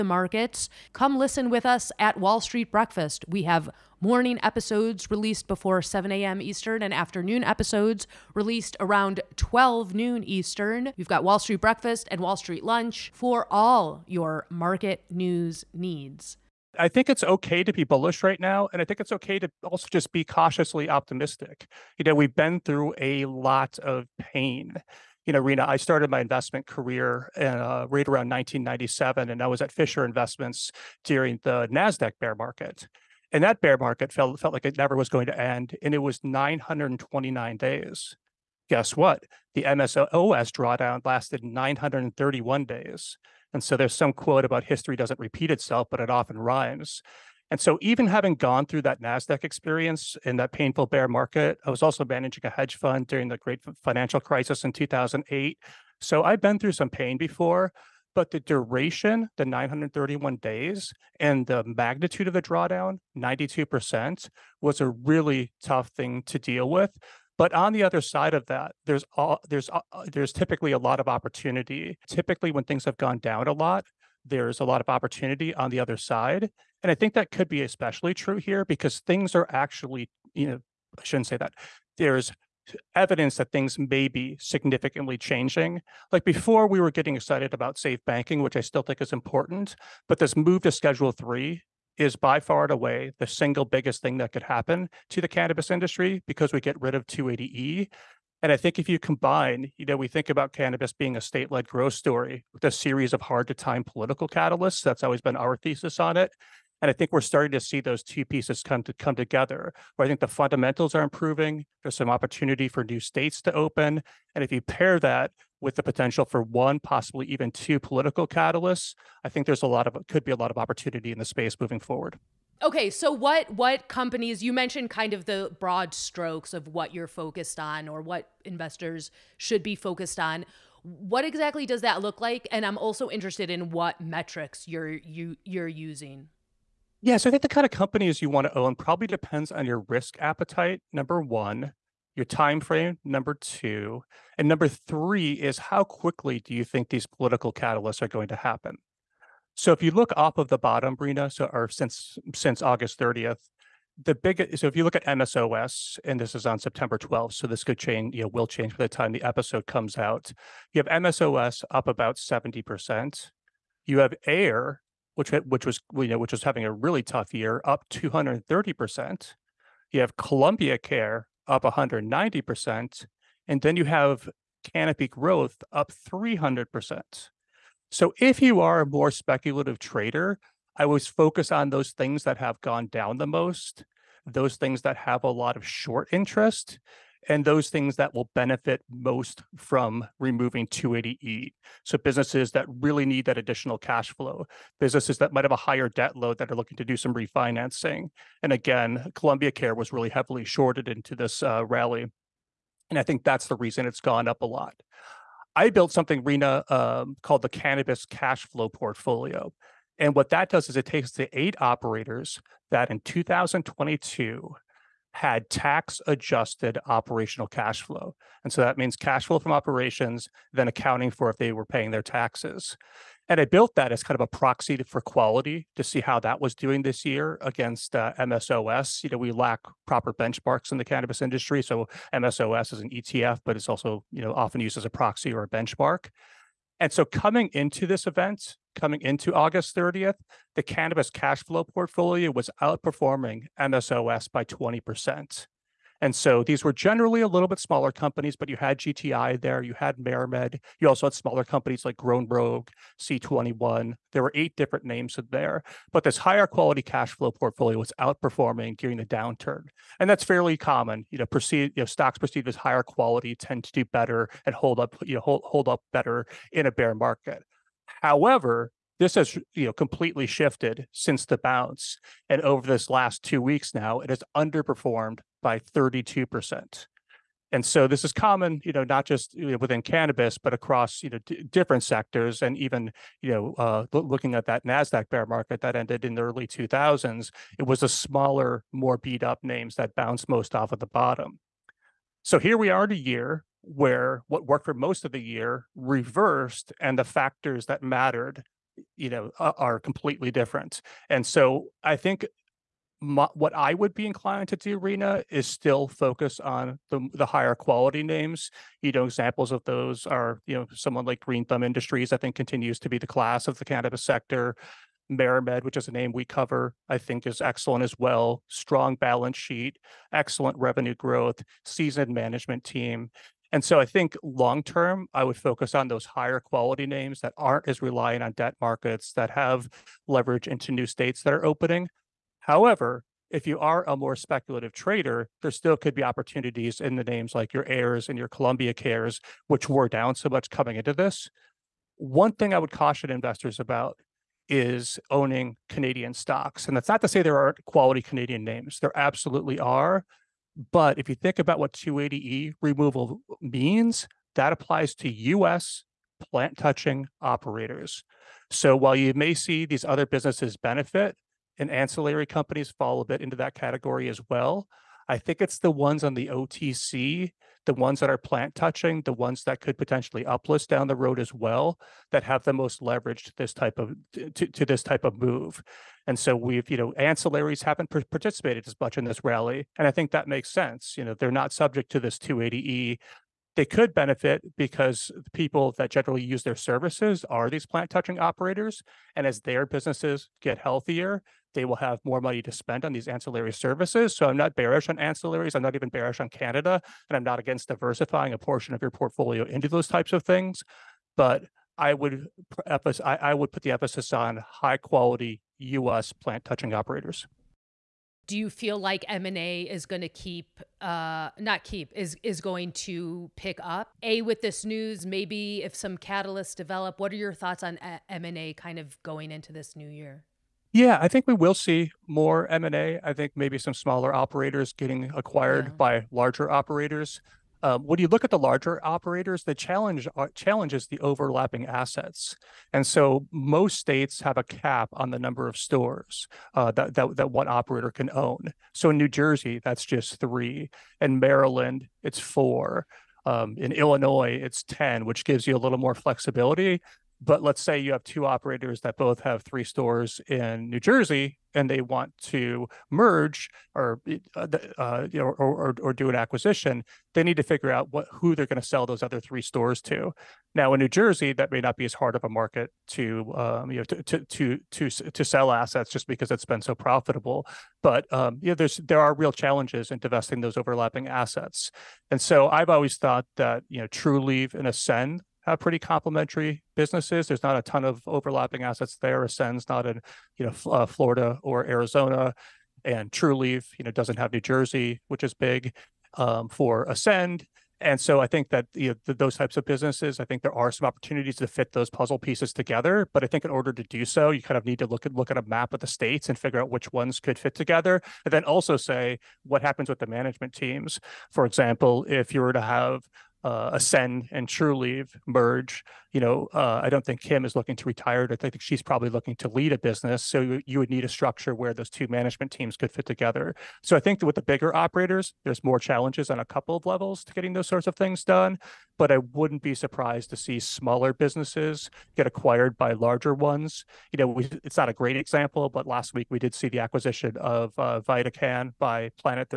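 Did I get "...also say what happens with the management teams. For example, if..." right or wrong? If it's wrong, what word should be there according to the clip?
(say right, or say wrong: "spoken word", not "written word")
right.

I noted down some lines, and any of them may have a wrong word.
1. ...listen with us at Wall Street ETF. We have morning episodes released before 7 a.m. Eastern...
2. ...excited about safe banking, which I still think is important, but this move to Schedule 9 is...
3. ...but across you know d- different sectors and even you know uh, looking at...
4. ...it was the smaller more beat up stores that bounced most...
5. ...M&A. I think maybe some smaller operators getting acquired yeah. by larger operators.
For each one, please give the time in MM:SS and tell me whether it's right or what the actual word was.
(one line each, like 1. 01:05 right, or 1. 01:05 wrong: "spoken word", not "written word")
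1. 00:01 wrong: "Breakfast", not "ETF"
2. 01:27 wrong: "3", not "9"
3. 04:40 right
4. 04:47 wrong: "names", not "stores"
5. 07:02 right.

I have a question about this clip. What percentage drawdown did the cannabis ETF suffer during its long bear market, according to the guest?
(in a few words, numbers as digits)
92%.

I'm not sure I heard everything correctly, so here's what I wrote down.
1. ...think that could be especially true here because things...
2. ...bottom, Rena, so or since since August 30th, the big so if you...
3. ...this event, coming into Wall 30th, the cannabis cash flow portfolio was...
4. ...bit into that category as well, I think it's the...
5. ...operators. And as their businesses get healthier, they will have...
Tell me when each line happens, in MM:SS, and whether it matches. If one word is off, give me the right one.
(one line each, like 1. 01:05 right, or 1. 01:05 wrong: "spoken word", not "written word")
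1. 01:16 right
2. 02:30 right
3. 03:57 wrong: "August", not "Wall"
4. 06:03 right
5. 06:28 right.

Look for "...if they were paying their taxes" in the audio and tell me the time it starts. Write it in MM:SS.
03:41.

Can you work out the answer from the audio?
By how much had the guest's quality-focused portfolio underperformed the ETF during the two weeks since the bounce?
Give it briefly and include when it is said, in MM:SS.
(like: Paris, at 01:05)
32%, at 04:35.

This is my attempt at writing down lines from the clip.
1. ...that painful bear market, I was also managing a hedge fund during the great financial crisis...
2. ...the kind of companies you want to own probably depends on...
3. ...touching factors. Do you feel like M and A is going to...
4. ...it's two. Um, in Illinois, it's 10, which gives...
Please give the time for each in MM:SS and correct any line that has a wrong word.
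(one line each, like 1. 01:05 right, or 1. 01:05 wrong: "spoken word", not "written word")
1. 00:50 right
2. 02:17 right
3. 06:46 wrong: "operators", not "factors"
4. 07:22 wrong: "four", not "two".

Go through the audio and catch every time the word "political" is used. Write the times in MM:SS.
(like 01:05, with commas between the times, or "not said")
01:43, 01:57, 02:27.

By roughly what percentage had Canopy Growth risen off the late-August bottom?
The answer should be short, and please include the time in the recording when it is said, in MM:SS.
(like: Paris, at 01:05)
300%, at 02:55.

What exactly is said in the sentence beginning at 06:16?
And so we've, you know, ancillaries haven't participated as much in this rally.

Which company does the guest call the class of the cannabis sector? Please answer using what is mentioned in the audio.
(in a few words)
Green Thumb Industries.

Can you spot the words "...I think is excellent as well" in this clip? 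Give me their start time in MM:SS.
05:16.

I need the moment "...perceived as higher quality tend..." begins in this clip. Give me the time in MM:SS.
04:22.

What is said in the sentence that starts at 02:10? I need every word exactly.
What exactly does that look like?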